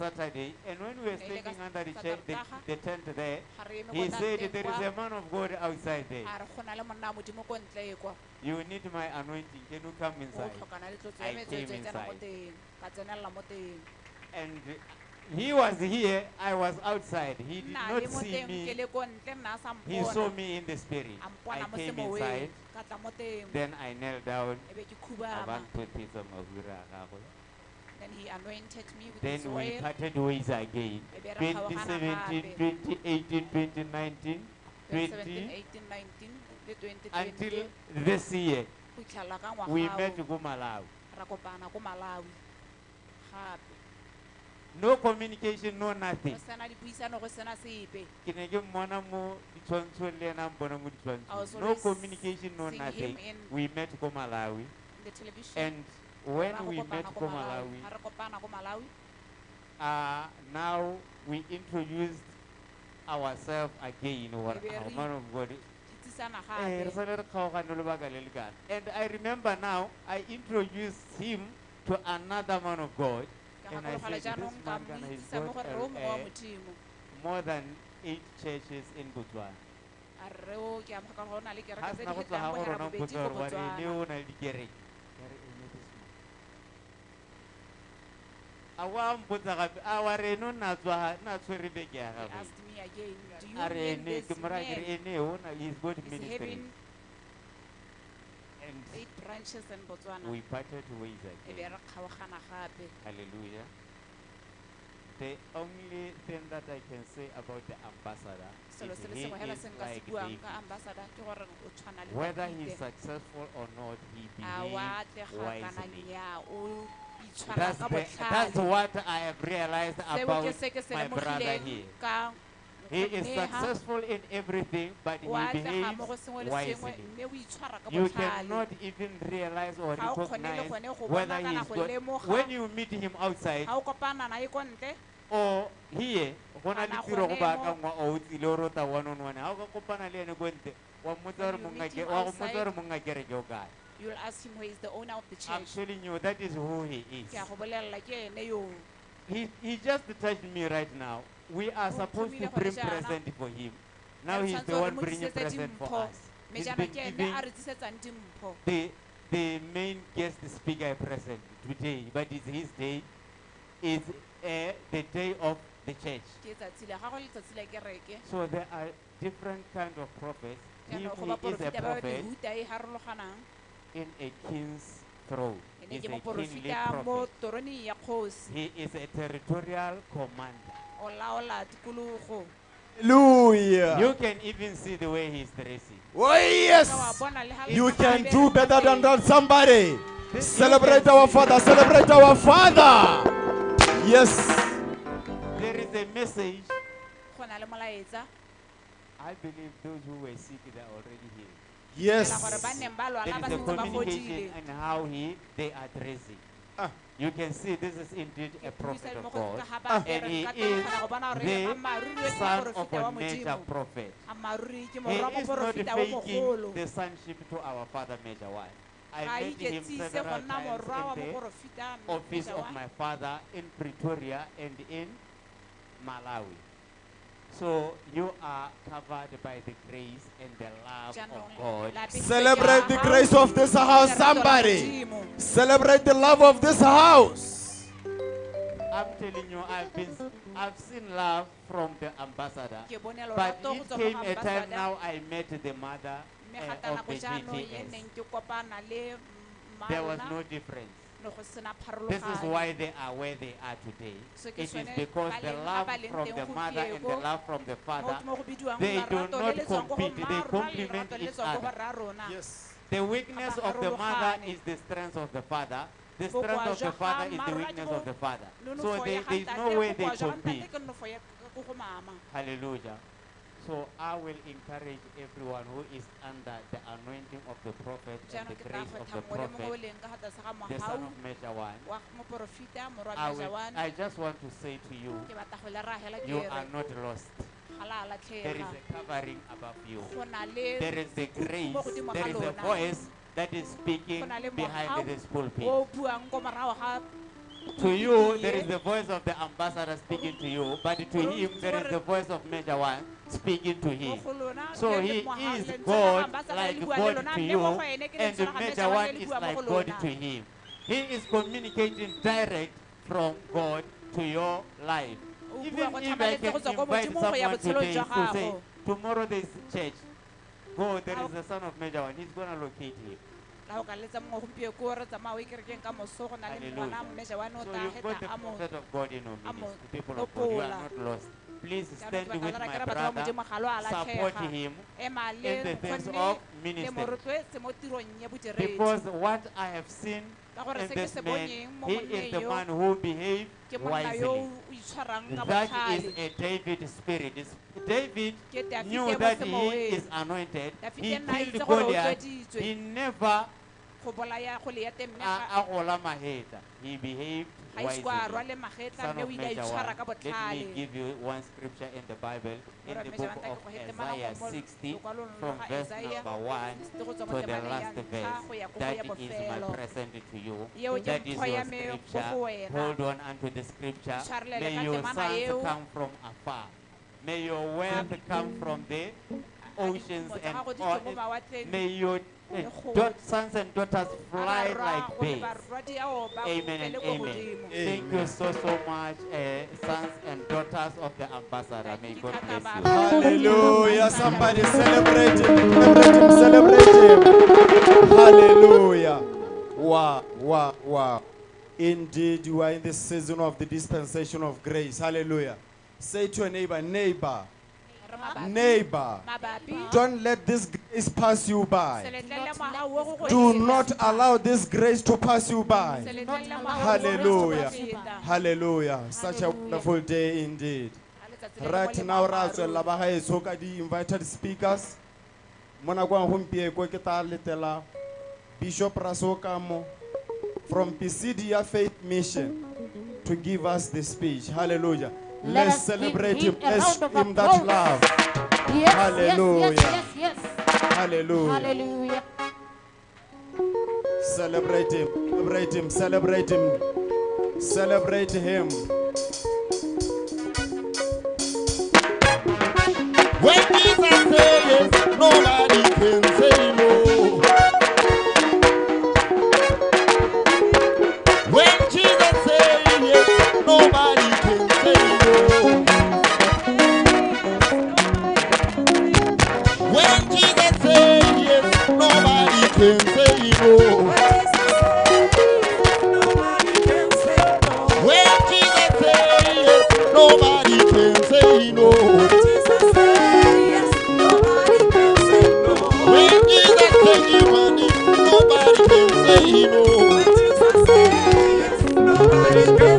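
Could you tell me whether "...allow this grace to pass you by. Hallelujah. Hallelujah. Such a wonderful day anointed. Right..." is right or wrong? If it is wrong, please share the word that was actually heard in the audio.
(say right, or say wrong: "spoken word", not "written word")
wrong: "indeed", not "anointed".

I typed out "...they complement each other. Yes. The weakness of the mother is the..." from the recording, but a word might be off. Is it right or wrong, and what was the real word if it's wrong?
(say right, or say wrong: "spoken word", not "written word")
right.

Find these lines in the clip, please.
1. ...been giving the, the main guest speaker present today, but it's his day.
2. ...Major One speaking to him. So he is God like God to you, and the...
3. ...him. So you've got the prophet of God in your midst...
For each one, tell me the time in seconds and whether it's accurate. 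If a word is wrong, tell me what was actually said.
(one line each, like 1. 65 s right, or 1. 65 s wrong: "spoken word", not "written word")
1. 156 s right
2. 302 s right
3. 323 s right.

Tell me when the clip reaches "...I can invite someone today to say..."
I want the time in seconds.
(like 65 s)
315 s.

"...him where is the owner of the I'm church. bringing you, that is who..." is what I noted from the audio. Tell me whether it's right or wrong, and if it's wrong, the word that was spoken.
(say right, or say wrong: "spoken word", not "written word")
wrong: "telling", not "bringing".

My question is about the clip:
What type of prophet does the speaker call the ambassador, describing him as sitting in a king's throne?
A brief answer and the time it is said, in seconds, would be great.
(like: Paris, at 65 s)
Kingly prophet, at 176 s.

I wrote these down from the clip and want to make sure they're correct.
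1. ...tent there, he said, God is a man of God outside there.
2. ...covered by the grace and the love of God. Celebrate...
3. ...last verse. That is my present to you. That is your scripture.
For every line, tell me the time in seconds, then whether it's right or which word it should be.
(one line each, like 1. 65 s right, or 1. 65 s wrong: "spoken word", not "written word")
1. 2 s wrong: "There", not "God"
2. 228 s right
3. 367 s right.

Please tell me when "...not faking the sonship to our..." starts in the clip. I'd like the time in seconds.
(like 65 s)
214 s.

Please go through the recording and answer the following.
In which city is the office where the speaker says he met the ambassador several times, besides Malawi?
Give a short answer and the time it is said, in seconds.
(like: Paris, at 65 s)
Pretoria, at 223 s.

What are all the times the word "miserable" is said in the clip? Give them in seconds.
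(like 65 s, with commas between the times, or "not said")
not said.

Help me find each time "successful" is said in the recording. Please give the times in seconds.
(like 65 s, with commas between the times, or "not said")
112 s, 123 s.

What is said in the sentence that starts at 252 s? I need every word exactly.
This is why they are where they are today.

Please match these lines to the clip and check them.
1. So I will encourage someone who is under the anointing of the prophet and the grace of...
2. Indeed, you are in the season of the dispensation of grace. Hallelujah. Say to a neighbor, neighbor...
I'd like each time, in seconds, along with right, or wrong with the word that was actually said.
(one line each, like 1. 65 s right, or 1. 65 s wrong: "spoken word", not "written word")
1. 273 s wrong: "everyone", not "someone"
2. 401 s right.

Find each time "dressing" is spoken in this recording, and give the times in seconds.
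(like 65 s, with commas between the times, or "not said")
185 s.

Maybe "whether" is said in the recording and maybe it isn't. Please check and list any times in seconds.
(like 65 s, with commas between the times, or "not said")
112 s, 131 s.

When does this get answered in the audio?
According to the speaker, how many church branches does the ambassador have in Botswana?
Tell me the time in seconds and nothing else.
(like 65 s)
77 s.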